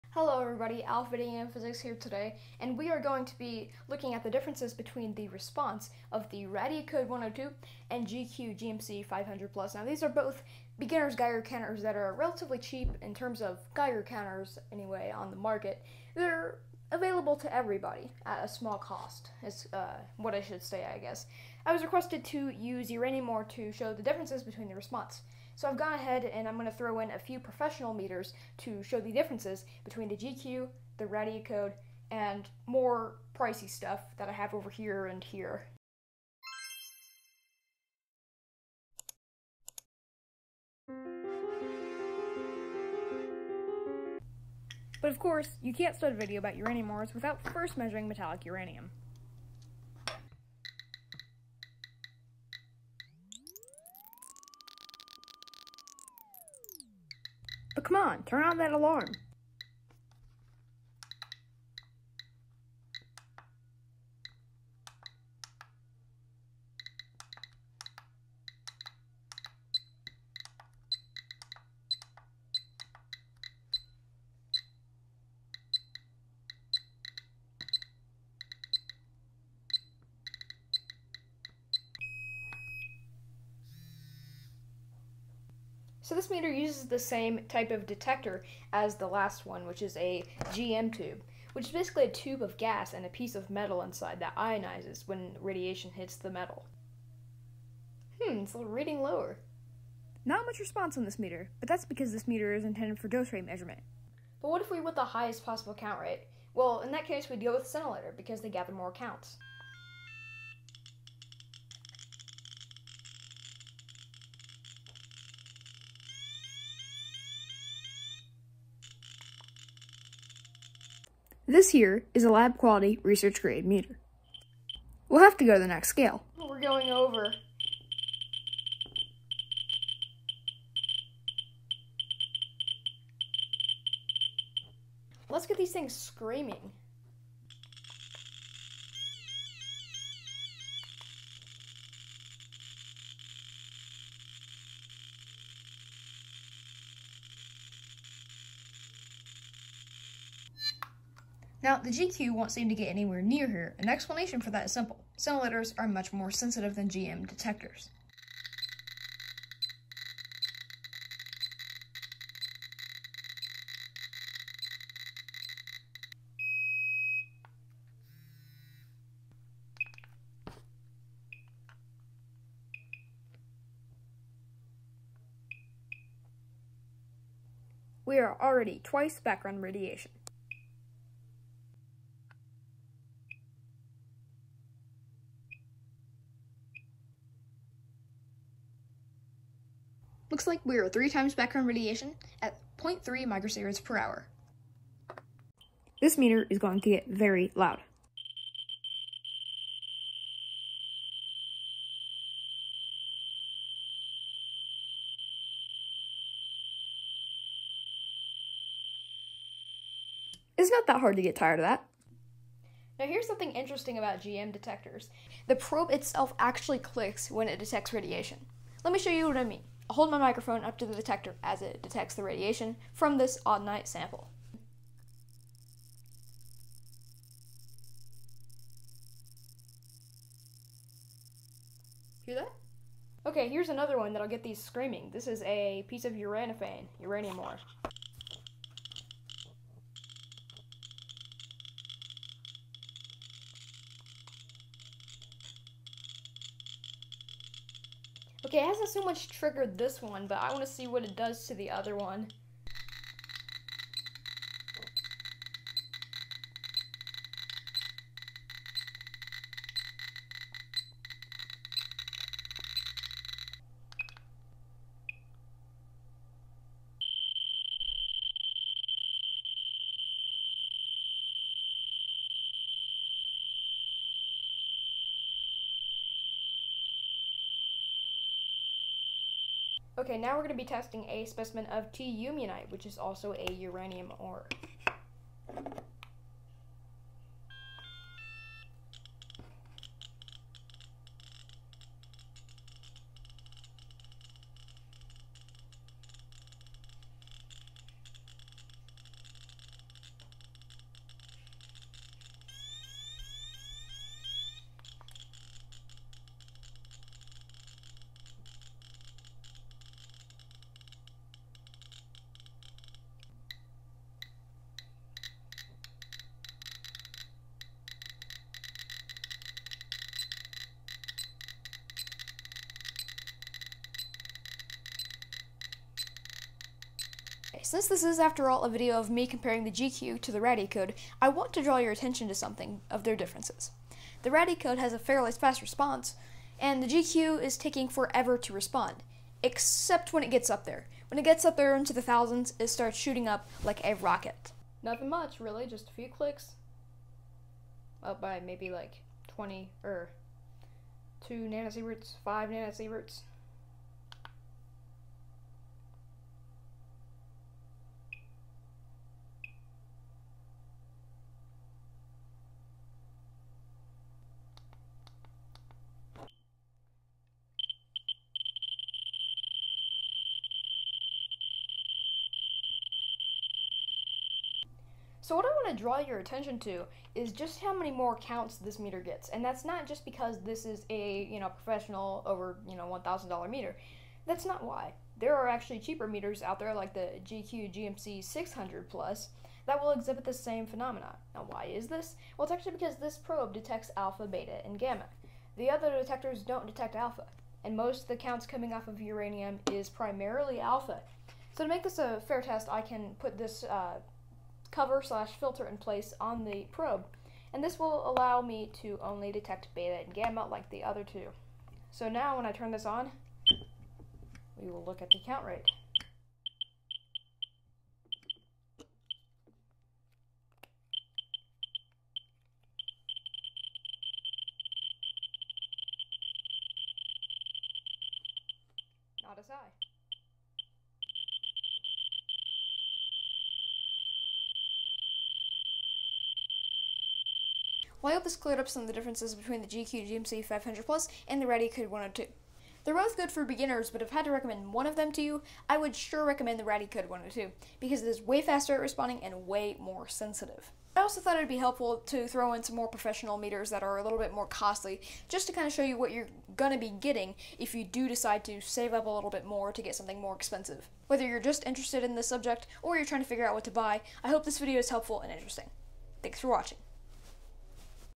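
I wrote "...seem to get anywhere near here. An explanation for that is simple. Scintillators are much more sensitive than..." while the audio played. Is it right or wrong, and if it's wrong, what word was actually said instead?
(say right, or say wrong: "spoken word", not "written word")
right.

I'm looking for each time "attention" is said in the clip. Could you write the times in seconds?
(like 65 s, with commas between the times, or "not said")
331 s, 376 s.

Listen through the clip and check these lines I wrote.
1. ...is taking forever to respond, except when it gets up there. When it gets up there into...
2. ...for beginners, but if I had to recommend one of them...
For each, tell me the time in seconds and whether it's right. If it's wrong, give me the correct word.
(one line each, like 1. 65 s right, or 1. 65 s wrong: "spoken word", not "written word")
1. 337 s right
2. 443 s right.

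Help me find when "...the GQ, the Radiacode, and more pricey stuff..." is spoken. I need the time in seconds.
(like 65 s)
30 s.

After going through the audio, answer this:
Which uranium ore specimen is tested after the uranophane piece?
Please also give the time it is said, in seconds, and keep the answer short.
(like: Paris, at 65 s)
Tyuyamunite, at 281 s.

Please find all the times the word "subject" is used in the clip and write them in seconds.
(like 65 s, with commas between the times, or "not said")
462 s.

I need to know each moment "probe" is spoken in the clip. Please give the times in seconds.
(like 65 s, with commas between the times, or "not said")
215 s, 393 s, 406 s.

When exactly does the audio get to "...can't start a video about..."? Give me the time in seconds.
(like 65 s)
45 s.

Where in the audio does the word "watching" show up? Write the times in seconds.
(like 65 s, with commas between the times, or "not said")
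466 s.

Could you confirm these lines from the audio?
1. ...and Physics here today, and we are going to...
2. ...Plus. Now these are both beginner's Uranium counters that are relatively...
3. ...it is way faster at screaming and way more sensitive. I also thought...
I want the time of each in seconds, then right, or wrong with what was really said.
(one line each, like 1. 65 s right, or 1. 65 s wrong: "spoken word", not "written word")
1. 1 s right
2. 9 s wrong: "Geiger", not "Uranium"
3. 448 s wrong: "responding", not "screaming".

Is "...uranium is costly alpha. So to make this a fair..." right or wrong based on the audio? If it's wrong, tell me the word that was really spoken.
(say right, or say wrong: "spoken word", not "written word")
wrong: "primarily", not "costly".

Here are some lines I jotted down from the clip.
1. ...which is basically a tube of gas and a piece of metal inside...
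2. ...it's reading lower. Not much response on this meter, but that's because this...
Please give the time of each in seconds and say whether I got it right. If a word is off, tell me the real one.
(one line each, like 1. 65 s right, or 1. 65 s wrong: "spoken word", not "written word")
1. 91 s right
2. 98 s right.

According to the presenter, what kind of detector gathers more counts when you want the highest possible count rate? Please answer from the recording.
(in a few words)
Scintillator.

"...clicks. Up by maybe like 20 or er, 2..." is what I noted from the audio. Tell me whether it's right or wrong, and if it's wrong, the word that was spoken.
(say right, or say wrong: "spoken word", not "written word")
right.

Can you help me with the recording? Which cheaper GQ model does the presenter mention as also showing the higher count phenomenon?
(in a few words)
GQ GMC 600 Plus.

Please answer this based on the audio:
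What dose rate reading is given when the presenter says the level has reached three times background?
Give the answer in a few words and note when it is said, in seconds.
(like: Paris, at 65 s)
0.3 microsieverts per hour, at 192 s.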